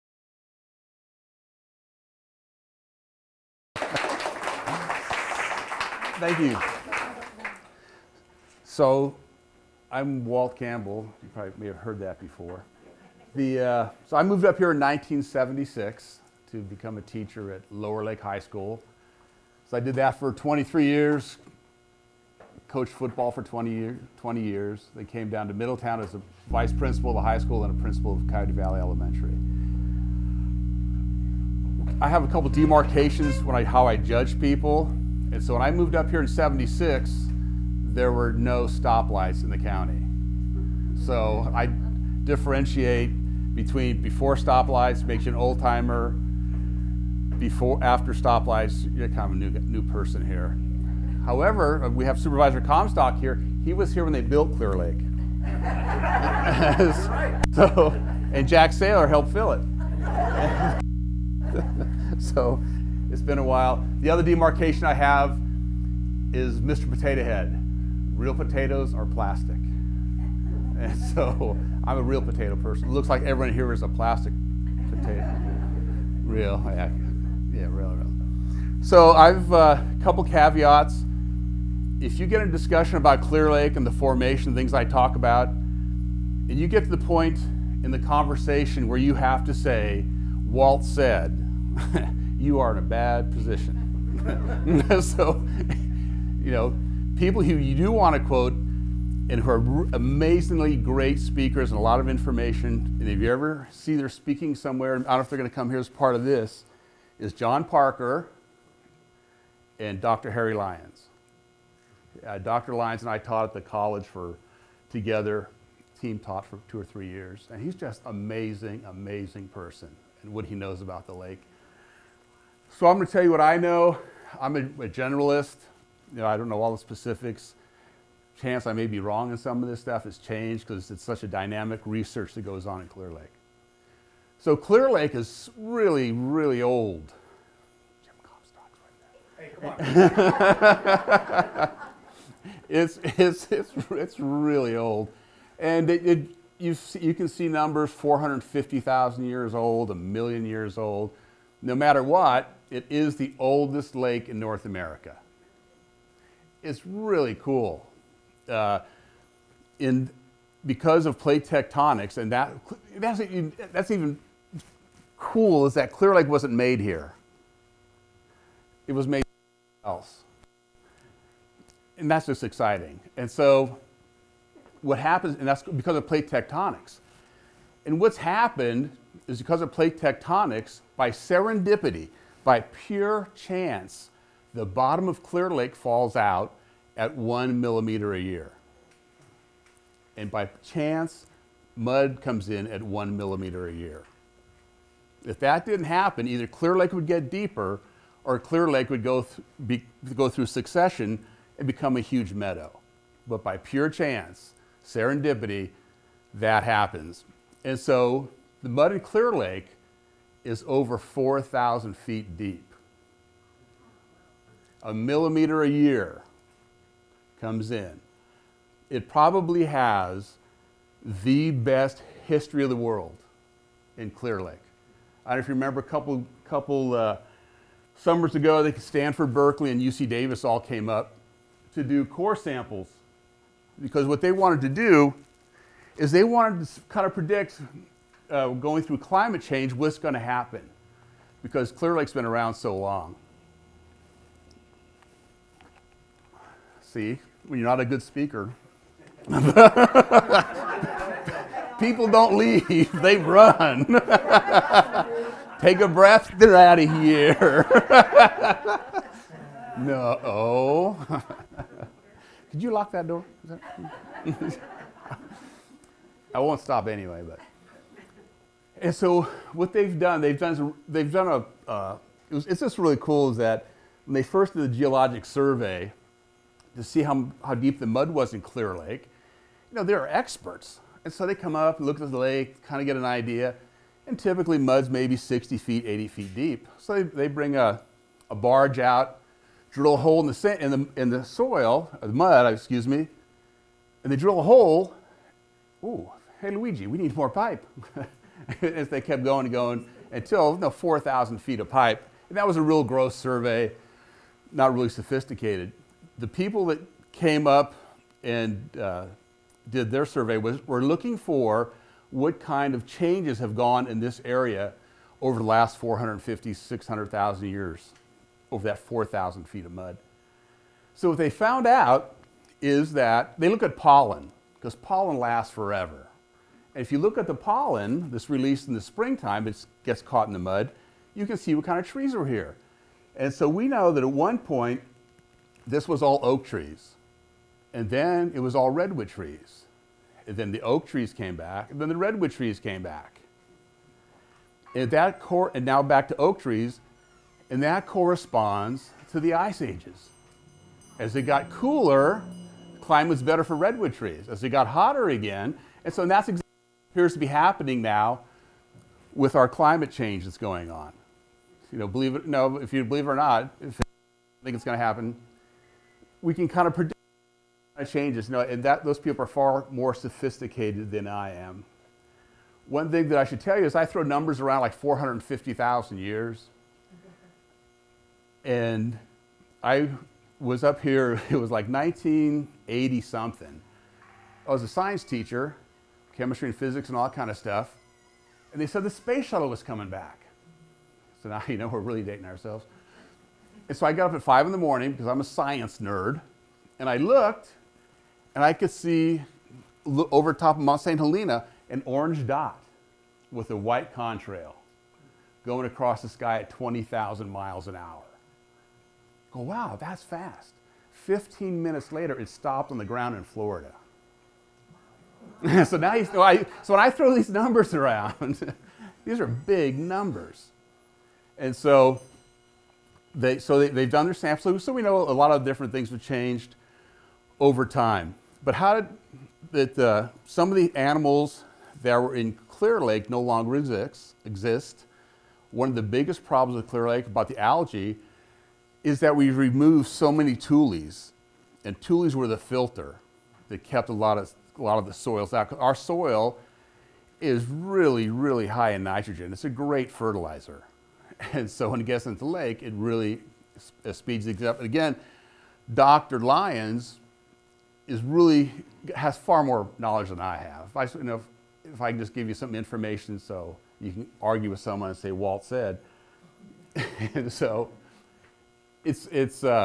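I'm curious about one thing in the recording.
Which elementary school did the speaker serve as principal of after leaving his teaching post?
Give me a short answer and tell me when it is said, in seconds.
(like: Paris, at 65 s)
Coyote Valley Elementary, at 28 s.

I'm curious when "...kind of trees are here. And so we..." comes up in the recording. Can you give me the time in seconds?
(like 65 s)
331 s.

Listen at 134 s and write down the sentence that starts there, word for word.
So Clear Lake is really, really old.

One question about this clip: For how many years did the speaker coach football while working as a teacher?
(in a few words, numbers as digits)
20.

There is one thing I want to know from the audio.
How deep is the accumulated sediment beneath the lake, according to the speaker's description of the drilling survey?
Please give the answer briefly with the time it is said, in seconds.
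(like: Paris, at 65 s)
over 4,000 feet, at 210 s.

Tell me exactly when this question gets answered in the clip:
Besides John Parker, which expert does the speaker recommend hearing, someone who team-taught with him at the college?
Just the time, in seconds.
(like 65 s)
109 s.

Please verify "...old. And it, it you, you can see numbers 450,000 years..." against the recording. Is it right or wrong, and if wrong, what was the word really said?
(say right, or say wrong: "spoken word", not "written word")
right.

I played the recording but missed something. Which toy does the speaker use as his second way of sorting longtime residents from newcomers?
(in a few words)
Mr. Potato Head.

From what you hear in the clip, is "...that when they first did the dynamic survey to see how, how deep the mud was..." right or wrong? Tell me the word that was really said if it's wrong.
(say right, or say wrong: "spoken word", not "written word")
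wrong: "geologic", not "dynamic".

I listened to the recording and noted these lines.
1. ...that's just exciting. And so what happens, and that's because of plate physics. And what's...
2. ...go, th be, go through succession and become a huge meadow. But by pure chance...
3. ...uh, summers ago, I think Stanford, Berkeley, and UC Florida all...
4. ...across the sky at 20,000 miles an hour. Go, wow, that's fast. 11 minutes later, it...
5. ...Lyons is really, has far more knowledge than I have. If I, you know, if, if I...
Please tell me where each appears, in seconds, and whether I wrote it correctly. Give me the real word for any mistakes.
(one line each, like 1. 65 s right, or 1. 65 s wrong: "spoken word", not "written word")
1. 172 s wrong: "tectonics", not "physics"
2. 199 s right
3. 226 s wrong: "Davis", not "Florida"
4. 405 s wrong: "15", not "11"
5. 456 s right.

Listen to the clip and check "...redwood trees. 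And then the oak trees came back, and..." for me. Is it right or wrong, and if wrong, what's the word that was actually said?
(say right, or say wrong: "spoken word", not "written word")
right.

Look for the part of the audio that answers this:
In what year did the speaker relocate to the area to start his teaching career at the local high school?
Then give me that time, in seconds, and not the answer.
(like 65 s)
14 s.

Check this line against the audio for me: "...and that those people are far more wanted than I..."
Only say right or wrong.
wrong.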